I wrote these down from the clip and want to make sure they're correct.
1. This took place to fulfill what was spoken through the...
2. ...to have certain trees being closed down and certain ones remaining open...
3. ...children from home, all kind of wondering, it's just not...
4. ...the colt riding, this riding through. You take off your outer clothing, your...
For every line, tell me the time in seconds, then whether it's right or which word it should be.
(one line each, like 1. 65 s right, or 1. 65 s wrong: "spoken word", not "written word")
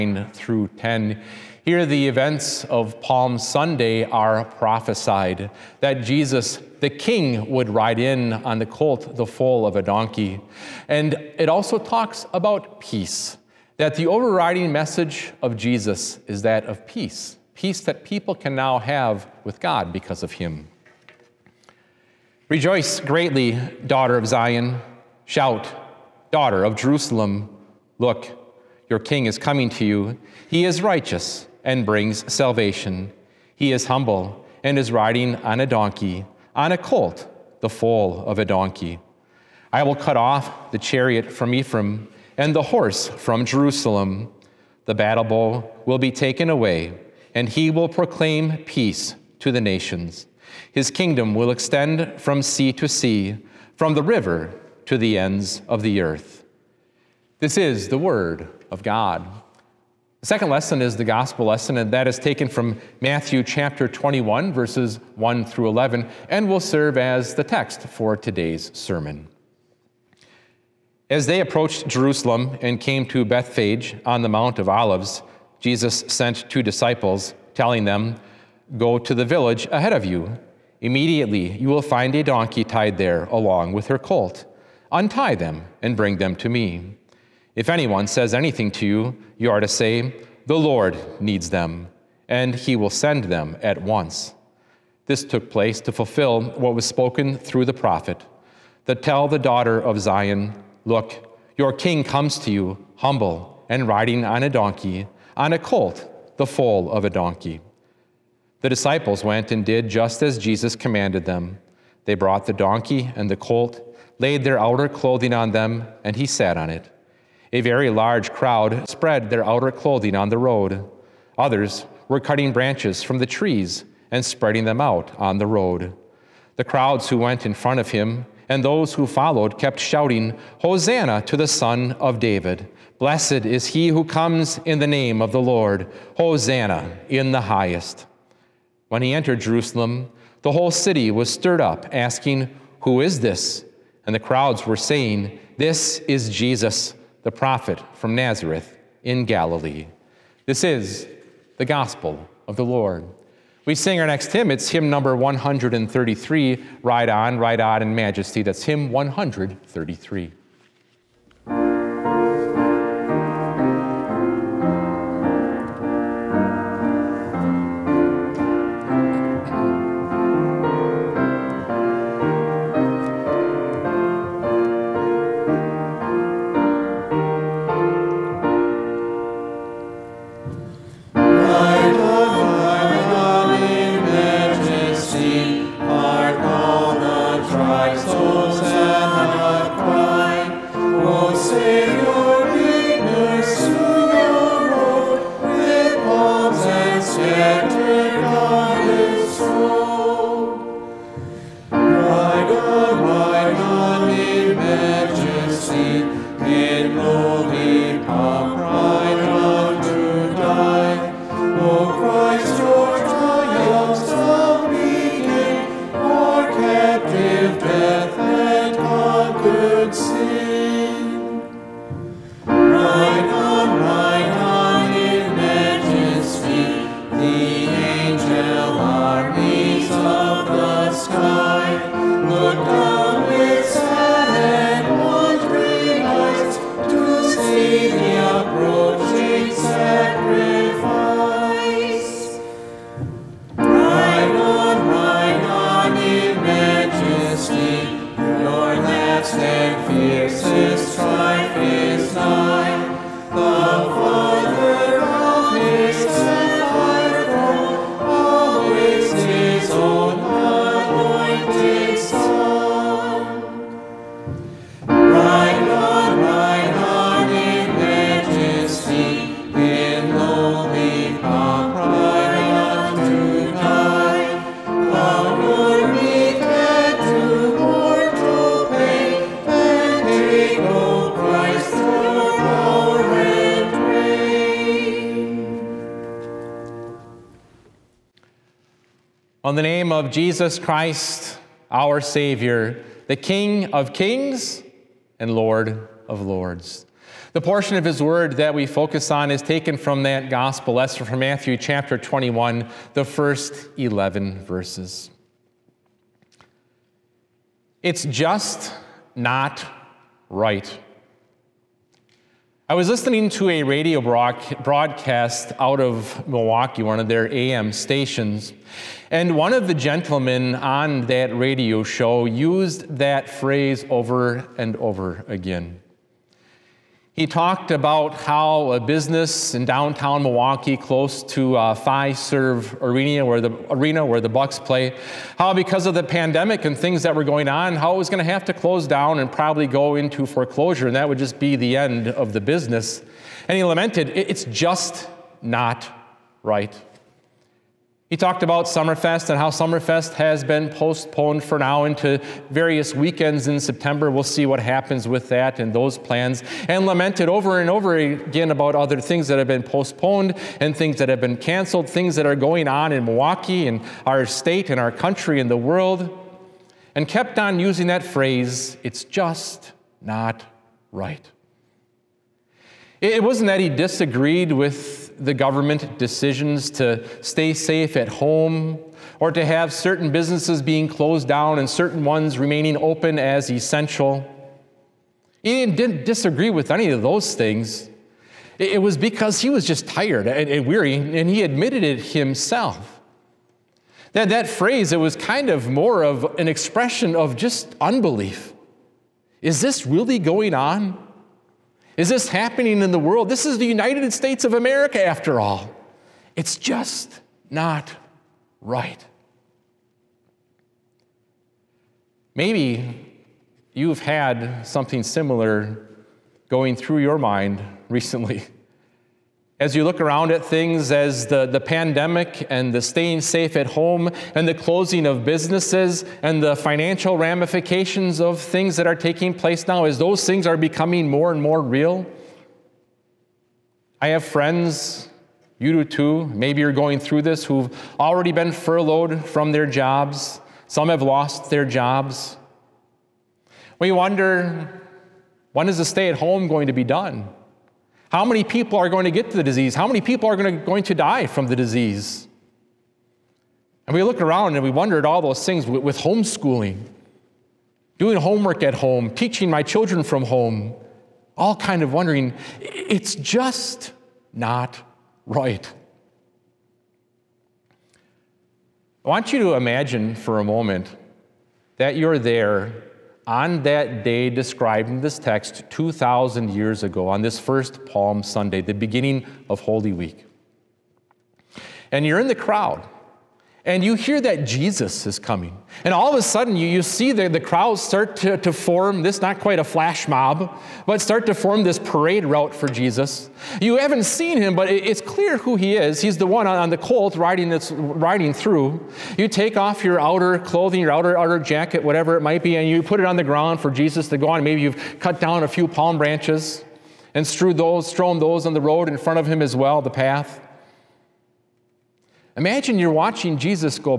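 1. 95 s right
2. 379 s wrong: "businesses", not "trees"
3. 459 s right
4. 496 s right.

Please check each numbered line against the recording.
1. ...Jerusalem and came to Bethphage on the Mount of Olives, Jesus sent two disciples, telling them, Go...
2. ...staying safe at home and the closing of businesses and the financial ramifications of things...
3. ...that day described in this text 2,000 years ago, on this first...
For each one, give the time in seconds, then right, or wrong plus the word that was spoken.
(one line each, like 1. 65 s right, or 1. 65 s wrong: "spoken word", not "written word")
1. 71 s right
2. 422 s right
3. 473 s right.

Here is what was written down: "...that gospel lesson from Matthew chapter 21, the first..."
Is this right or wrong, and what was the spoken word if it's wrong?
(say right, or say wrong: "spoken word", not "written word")
right.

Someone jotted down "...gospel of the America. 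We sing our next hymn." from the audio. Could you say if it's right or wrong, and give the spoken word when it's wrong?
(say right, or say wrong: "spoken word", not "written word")
wrong: "Lord", not "America".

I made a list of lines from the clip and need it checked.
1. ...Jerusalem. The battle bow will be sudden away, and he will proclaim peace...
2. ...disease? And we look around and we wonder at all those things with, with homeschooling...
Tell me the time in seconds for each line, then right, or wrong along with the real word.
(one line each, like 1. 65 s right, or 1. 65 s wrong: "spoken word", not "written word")
1. 43 s wrong: "taken", not "sudden"
2. 451 s right.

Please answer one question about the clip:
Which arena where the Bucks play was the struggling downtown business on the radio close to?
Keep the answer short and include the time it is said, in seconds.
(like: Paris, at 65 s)
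Fiserv Arena, at 331 s.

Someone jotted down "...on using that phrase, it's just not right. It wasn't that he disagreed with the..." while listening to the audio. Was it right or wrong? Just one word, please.
right.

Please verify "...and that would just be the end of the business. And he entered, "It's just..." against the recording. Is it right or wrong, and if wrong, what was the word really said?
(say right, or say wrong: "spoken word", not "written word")
wrong: "lamented", not "entered".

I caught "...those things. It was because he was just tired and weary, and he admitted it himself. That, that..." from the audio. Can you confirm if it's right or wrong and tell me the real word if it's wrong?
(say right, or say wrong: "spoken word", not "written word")
right.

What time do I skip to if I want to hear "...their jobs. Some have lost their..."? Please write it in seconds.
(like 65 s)
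439 s.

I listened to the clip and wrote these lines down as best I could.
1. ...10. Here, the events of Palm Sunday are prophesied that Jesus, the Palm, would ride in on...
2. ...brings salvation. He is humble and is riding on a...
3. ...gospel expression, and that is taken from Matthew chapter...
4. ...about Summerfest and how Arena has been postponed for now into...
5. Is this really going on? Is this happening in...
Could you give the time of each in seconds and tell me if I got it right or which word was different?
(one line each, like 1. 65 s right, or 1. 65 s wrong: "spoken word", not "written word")
1. 0 s wrong: "King", not "Palm"
2. 31 s right
3. 61 s wrong: "lesson", not "expression"
4. 348 s wrong: "Summerfest", not "Arena"
5. 399 s right.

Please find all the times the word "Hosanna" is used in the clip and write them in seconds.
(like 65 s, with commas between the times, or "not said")
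130 s, 136 s.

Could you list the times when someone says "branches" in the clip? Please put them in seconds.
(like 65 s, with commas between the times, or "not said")
122 s, 505 s.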